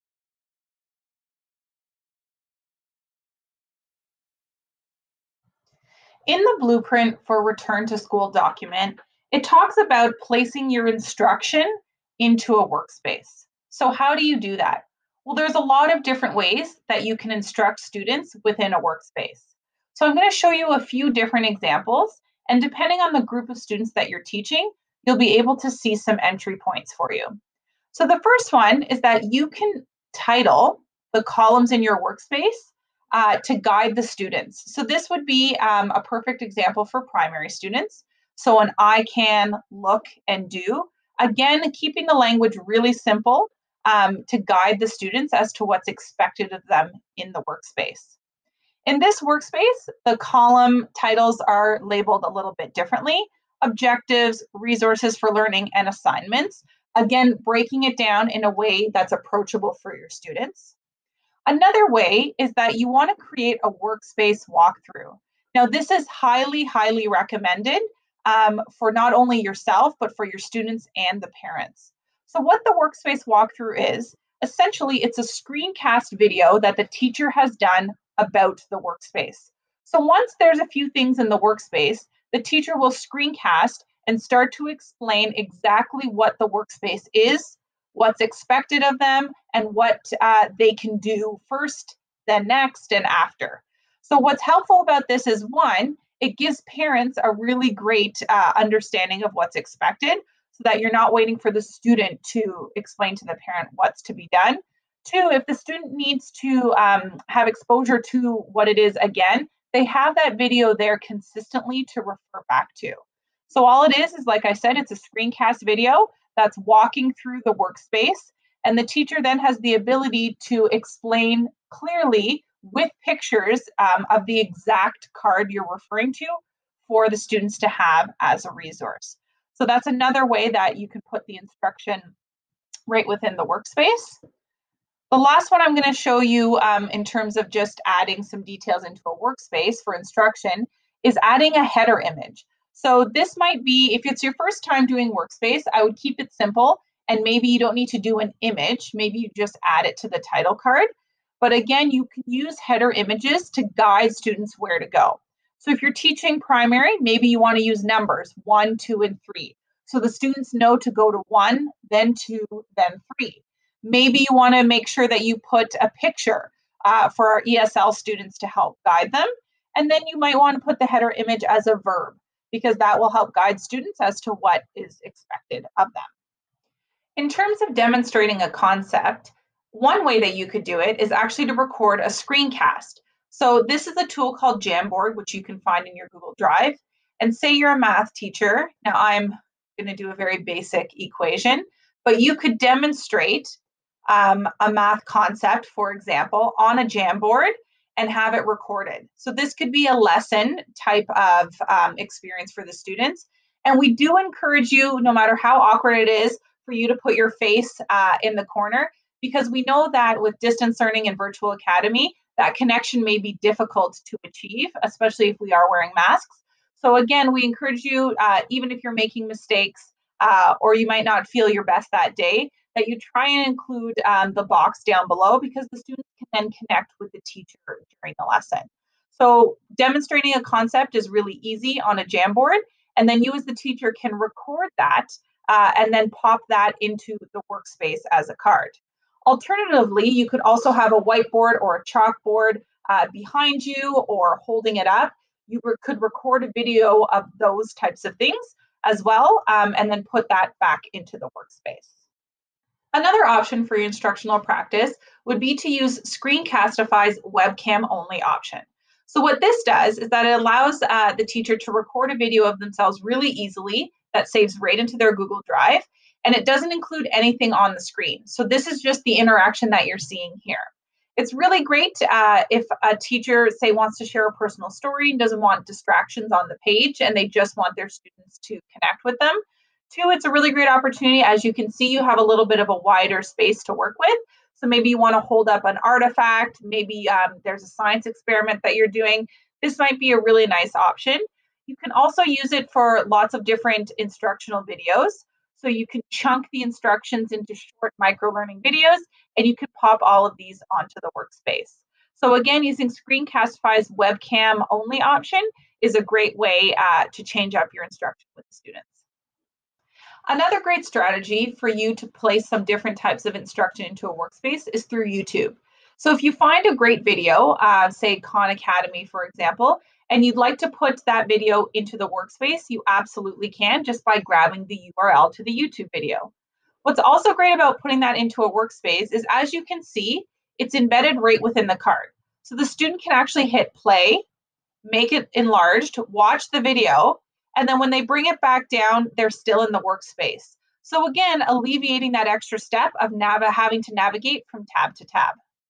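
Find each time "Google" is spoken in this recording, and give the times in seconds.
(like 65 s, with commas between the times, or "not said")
186 s, 265 s.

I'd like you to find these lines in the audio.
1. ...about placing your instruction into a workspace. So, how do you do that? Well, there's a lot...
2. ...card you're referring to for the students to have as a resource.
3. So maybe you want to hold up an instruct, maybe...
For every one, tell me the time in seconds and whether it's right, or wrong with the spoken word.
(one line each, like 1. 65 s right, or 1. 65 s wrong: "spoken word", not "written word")
1. 9 s right
2. 125 s right
3. 284 s wrong: "artifact", not "instruct".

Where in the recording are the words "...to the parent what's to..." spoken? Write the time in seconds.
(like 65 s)
103 s.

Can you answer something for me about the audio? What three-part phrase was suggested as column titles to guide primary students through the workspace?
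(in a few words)
I can look and do.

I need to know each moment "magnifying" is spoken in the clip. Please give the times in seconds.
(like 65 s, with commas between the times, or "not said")
not said.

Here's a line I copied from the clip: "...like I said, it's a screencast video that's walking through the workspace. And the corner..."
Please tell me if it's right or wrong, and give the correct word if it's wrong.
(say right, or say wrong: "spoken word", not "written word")
wrong: "teacher", not "corner".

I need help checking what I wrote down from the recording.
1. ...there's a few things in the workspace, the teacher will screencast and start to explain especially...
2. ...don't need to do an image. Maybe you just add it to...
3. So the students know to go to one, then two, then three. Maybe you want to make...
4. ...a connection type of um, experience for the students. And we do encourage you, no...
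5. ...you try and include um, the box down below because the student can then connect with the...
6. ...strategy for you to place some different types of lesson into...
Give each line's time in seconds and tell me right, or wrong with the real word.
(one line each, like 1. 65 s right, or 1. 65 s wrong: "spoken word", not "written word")
1. 80 s wrong: "exactly", not "especially"
2. 147 s right
3. 159 s right
4. 199 s wrong: "lesson", not "connection"
5. 222 s right
6. 310 s wrong: "instruction", not "lesson".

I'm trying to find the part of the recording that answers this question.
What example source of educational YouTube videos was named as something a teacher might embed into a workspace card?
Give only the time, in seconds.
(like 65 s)
318 s.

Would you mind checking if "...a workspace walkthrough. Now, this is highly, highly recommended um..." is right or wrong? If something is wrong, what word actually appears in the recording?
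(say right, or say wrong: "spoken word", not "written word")
right.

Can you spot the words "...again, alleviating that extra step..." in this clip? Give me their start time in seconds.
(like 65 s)
341 s.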